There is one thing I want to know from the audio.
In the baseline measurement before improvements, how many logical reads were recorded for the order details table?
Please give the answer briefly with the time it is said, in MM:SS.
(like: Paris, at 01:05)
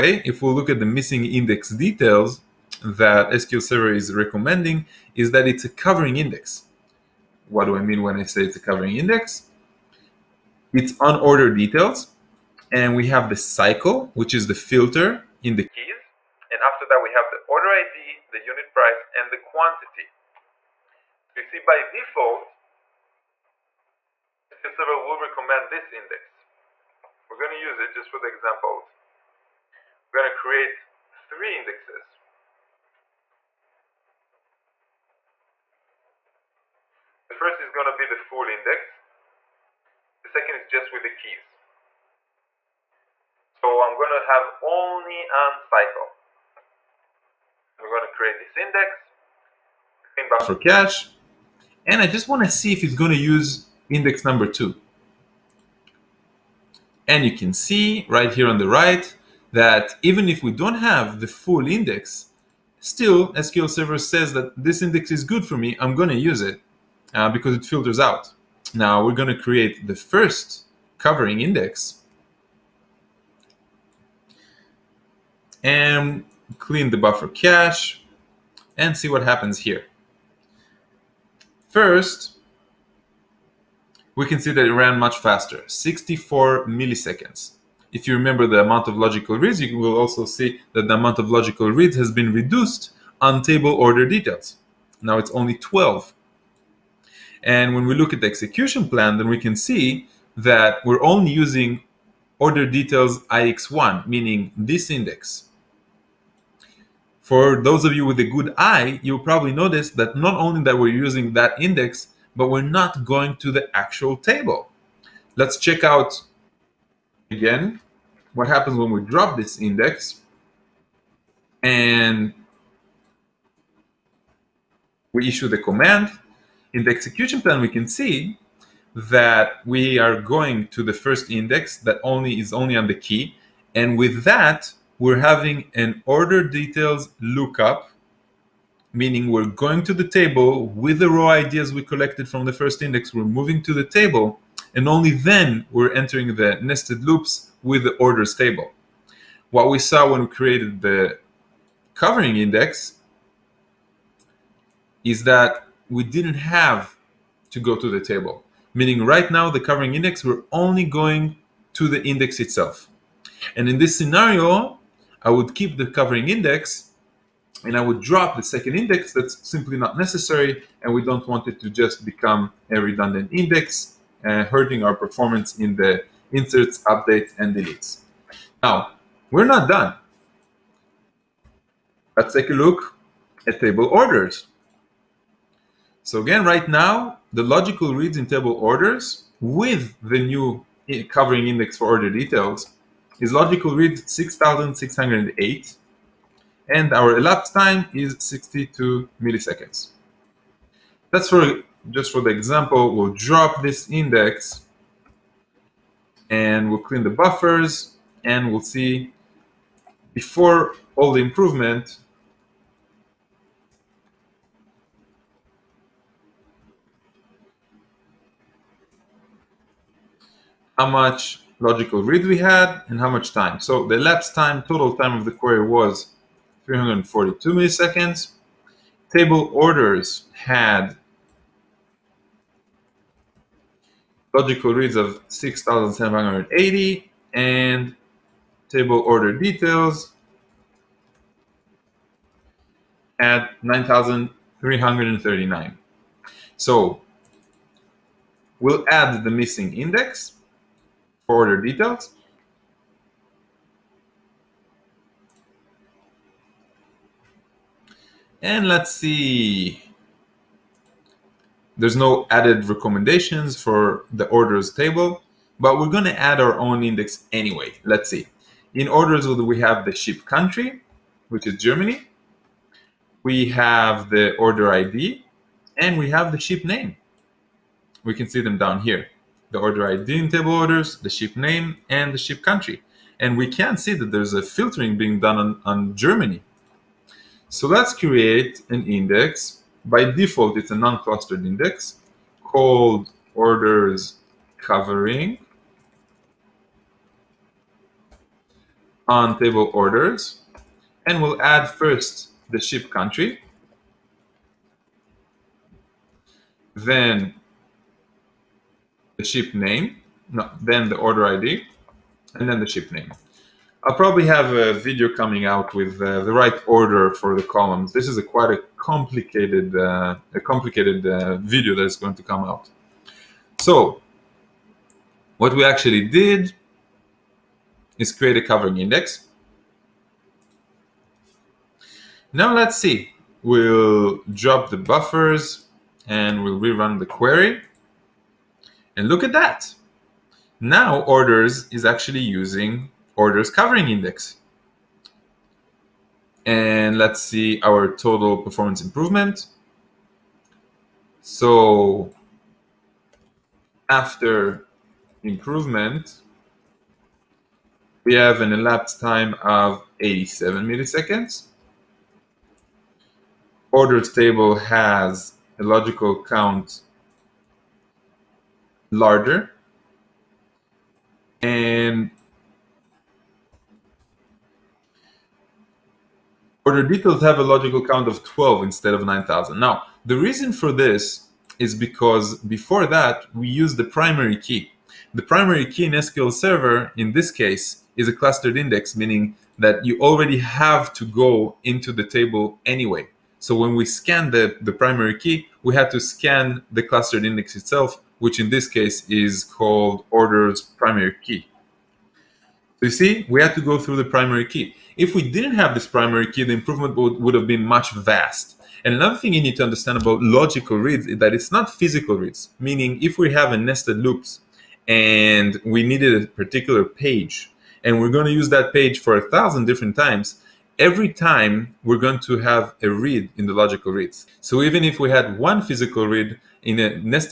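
9,339, at 04:03.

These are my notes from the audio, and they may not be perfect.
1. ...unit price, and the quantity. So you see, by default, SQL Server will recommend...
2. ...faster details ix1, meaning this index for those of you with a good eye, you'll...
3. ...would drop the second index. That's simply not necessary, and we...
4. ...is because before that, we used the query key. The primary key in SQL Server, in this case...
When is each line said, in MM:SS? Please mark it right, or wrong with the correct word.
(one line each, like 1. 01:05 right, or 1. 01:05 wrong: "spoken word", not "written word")
1. 00:18 right
2. 01:42 wrong: "order", not "faster"
3. 02:47 right
4. 06:21 wrong: "primary", not "query".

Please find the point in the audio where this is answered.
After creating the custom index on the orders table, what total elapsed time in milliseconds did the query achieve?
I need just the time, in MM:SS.
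05:59.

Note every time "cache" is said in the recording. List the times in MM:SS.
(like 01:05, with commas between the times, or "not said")
00:50, 01:17.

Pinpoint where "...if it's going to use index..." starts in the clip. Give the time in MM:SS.
00:52.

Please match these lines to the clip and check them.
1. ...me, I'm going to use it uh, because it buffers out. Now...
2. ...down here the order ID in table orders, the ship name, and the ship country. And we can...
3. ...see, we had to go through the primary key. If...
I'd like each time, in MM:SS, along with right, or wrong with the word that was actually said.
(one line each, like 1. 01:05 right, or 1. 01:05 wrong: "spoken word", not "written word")
1. 01:05 wrong: "filters", not "buffers"
2. 04:38 right
3. 06:42 right.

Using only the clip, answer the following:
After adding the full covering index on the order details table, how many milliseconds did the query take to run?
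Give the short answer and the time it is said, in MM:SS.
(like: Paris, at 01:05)
64, at 01:25.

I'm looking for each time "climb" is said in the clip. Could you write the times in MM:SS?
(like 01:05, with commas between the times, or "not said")
not said.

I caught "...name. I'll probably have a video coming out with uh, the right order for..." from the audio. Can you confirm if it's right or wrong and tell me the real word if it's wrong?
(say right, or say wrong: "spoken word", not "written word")
right.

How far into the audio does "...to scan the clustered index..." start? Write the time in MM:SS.
06:35.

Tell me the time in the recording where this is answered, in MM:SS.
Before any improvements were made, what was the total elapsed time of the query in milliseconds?
03:46.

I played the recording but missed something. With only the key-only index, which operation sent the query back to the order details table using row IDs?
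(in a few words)
Order details lookup.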